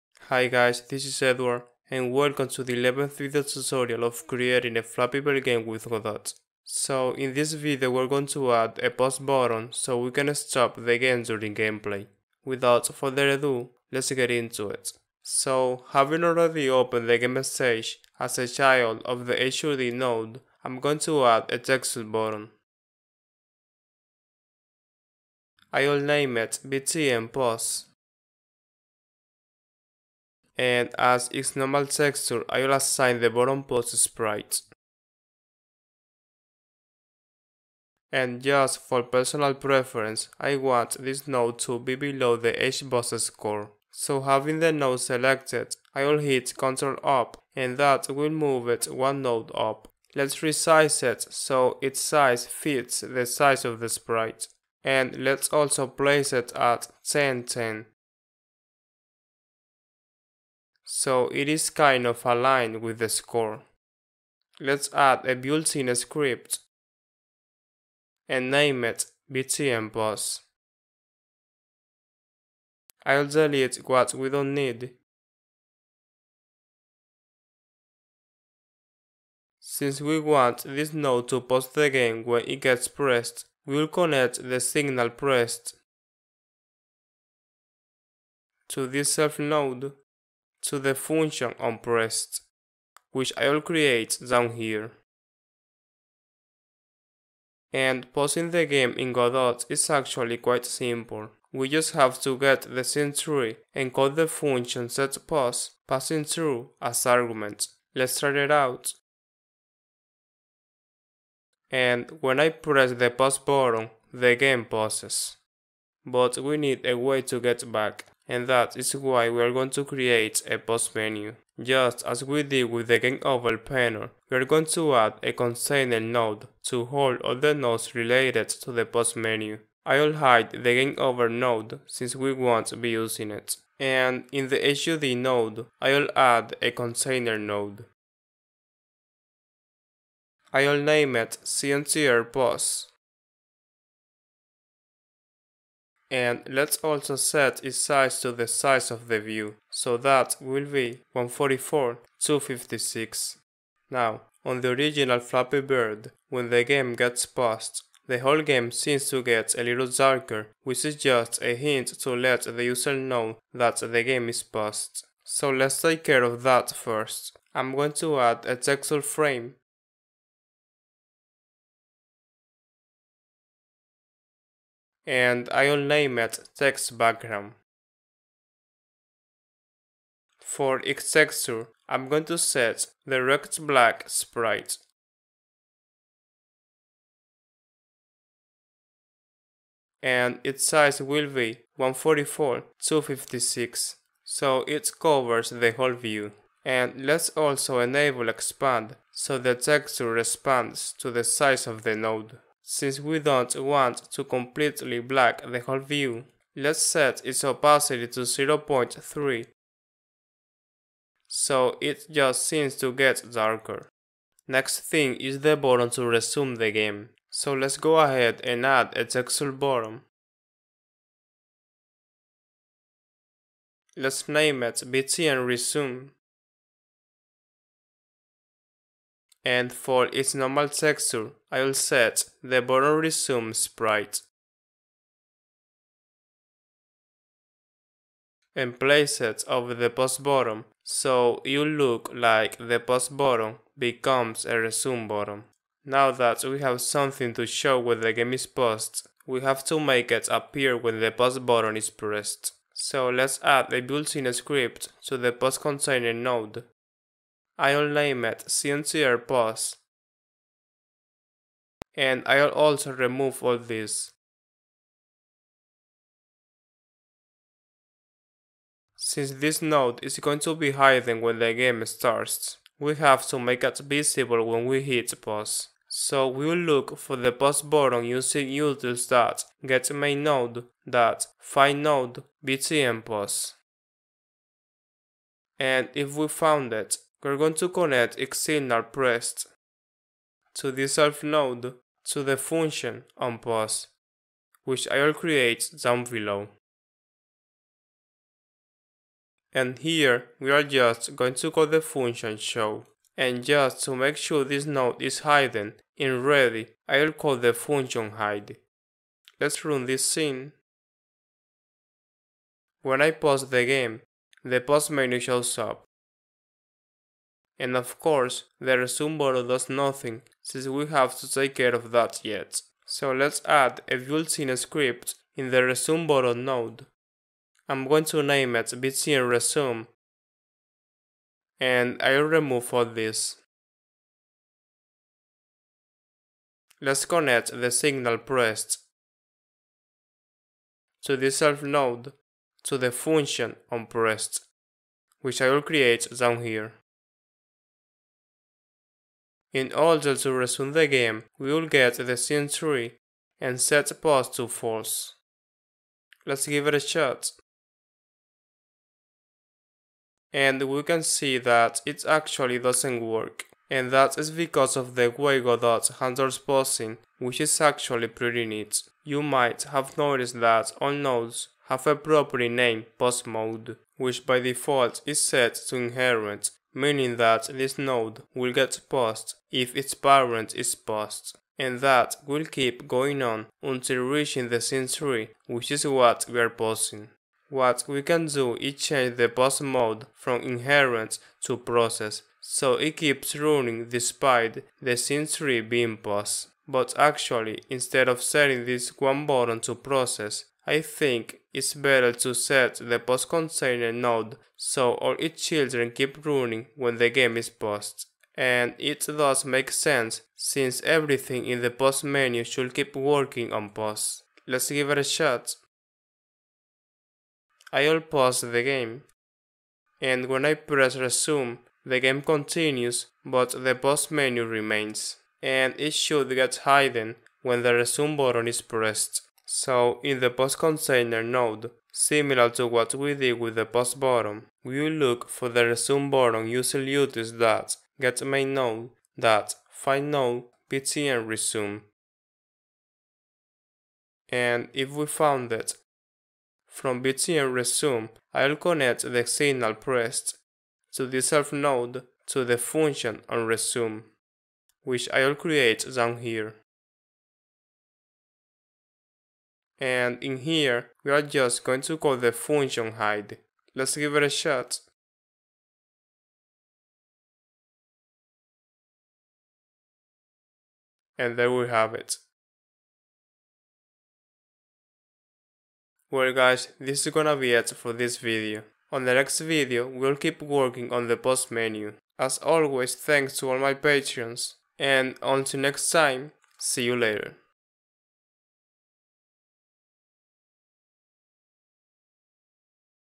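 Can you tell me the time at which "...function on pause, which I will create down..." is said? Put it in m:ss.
4:52.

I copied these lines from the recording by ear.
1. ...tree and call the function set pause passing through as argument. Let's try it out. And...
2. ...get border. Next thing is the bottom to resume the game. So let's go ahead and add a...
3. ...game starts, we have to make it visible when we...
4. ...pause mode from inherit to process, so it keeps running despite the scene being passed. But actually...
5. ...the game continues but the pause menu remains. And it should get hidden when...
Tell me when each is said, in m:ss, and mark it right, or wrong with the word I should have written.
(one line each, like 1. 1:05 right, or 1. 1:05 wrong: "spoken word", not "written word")
1. 1:43 right
2. 3:32 wrong: "darker", not "border"
3. 4:31 right
4. 6:29 right
5. 7:01 right.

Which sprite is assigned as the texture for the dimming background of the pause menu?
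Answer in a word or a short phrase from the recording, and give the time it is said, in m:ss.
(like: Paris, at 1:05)
rect Black, at 3:03.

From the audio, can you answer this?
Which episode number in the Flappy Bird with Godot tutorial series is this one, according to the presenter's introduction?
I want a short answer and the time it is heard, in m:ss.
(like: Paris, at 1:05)
11th, at 0:02.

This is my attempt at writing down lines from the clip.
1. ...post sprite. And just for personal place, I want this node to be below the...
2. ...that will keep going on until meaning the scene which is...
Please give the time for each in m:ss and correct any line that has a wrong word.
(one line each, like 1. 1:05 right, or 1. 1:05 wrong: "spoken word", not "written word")
1. 0:33 wrong: "preference", not "place"
2. 6:21 wrong: "reaching", not "meaning".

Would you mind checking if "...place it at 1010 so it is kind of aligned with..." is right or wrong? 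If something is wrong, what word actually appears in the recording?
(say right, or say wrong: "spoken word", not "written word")
right.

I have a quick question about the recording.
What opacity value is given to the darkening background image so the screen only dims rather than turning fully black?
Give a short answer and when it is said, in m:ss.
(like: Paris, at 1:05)
0.3, at 3:28.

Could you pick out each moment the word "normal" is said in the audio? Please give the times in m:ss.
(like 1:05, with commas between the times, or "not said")
0:31, 3:50.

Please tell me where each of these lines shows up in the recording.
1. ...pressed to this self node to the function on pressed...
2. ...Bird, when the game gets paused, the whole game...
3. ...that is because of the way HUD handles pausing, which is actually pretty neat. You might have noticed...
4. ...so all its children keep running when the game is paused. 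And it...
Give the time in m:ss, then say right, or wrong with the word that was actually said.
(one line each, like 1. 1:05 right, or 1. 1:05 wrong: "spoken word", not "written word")
1. 1:25 right
2. 2:35 right
3. 6:03 wrong: "Godot", not "HUD"
4. 6:44 right.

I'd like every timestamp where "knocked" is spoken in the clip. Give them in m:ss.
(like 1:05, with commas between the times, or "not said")
not said.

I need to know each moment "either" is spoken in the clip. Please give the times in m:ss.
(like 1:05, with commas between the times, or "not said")
not said.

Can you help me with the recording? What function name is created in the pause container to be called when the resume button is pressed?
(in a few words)
on resume.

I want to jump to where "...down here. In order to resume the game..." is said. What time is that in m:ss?
5:46.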